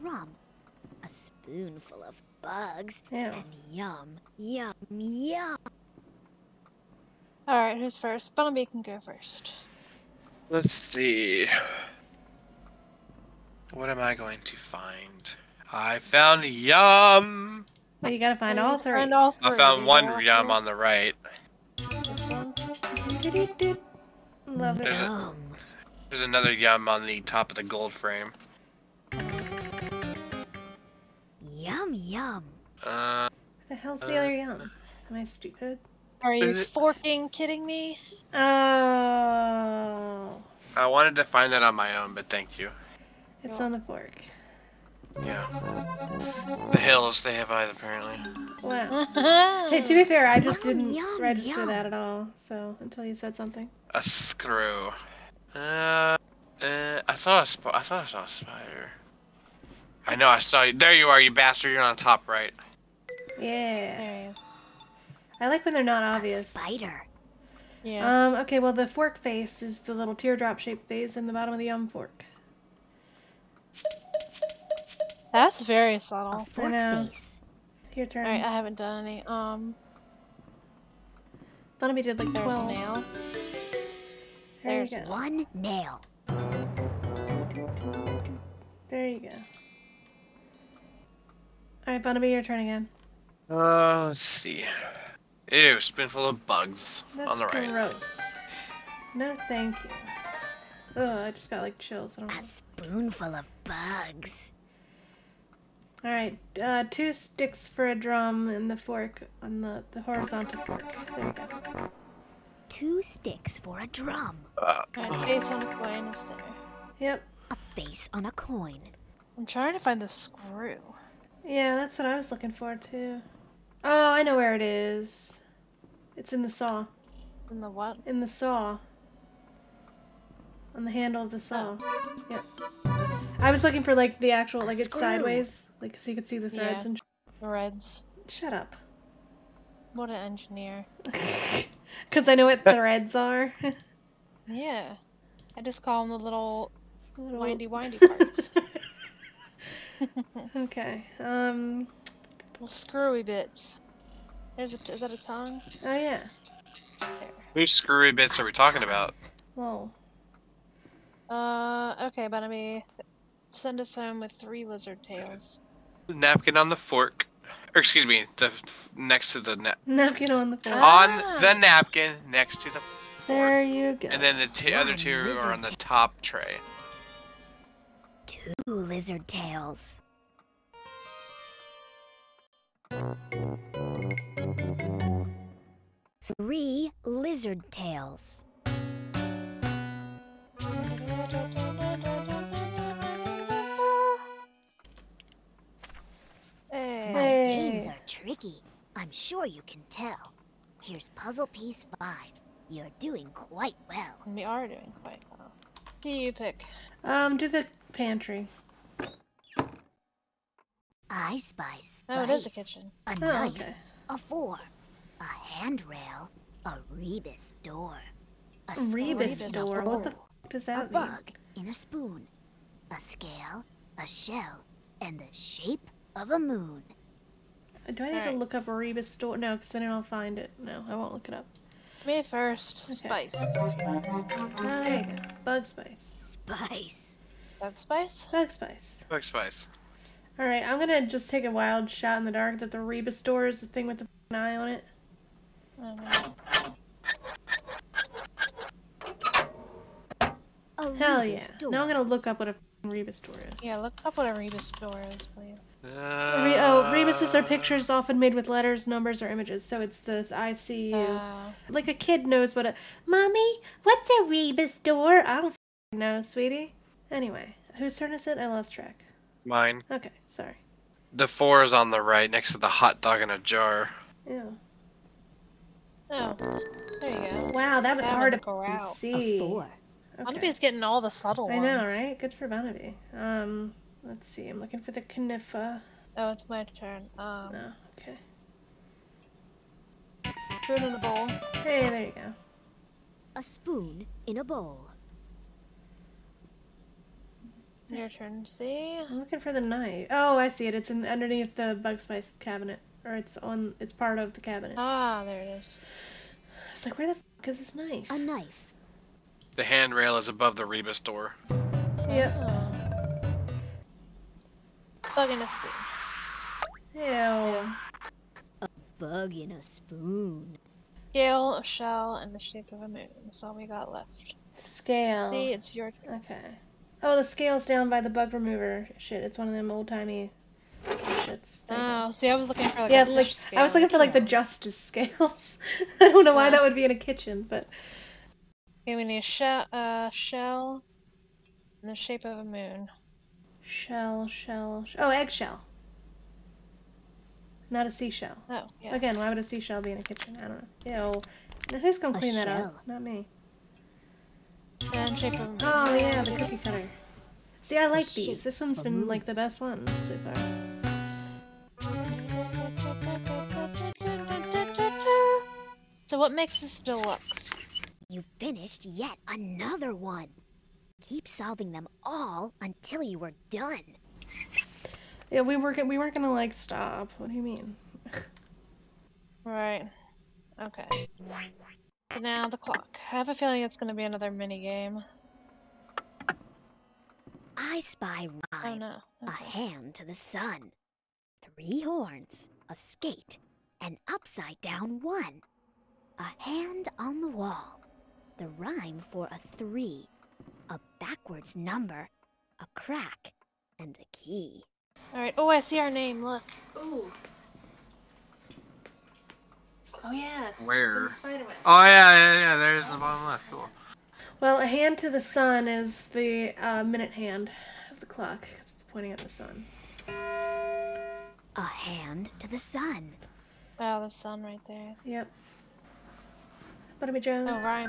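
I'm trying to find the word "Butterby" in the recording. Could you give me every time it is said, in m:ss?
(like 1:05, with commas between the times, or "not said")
7:07.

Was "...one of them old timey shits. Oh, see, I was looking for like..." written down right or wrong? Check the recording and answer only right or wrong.
right.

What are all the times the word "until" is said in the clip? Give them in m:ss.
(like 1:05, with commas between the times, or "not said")
0:52, 6:12.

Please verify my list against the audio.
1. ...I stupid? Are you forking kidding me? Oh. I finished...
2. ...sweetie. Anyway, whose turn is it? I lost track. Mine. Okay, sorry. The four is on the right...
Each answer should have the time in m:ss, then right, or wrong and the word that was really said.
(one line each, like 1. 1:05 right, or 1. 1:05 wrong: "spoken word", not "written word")
1. 0:35 wrong: "wanted", not "finished"
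2. 4:26 right.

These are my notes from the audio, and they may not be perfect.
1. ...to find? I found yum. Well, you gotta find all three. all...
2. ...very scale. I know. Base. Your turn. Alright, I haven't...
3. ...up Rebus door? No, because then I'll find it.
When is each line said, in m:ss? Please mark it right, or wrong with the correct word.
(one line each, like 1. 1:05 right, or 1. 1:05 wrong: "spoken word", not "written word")
1. 0:14 right
2. 1:15 wrong: "subtle", not "scale"
3. 3:48 right.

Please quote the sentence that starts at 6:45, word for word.
Alright, oh, I see our name, look.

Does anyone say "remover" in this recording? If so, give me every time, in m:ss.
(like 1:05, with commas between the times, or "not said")
5:28.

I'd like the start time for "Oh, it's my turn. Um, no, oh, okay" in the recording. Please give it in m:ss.
4:46.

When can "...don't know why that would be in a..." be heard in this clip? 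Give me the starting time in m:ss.
5:36.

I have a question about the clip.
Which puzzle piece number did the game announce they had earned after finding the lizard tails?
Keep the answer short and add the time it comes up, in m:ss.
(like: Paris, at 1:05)
5, at 3:21.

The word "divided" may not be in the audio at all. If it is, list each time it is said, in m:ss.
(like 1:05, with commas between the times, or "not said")
not said.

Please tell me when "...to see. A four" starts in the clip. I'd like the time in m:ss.
4:38.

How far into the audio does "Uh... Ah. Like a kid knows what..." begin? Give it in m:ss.
4:20.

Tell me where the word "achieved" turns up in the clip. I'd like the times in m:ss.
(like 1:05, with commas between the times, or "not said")
not said.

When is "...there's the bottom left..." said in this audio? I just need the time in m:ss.
6:52.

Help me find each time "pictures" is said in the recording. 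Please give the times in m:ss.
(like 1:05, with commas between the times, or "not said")
4:17.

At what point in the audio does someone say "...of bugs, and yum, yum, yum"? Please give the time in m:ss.
0:02.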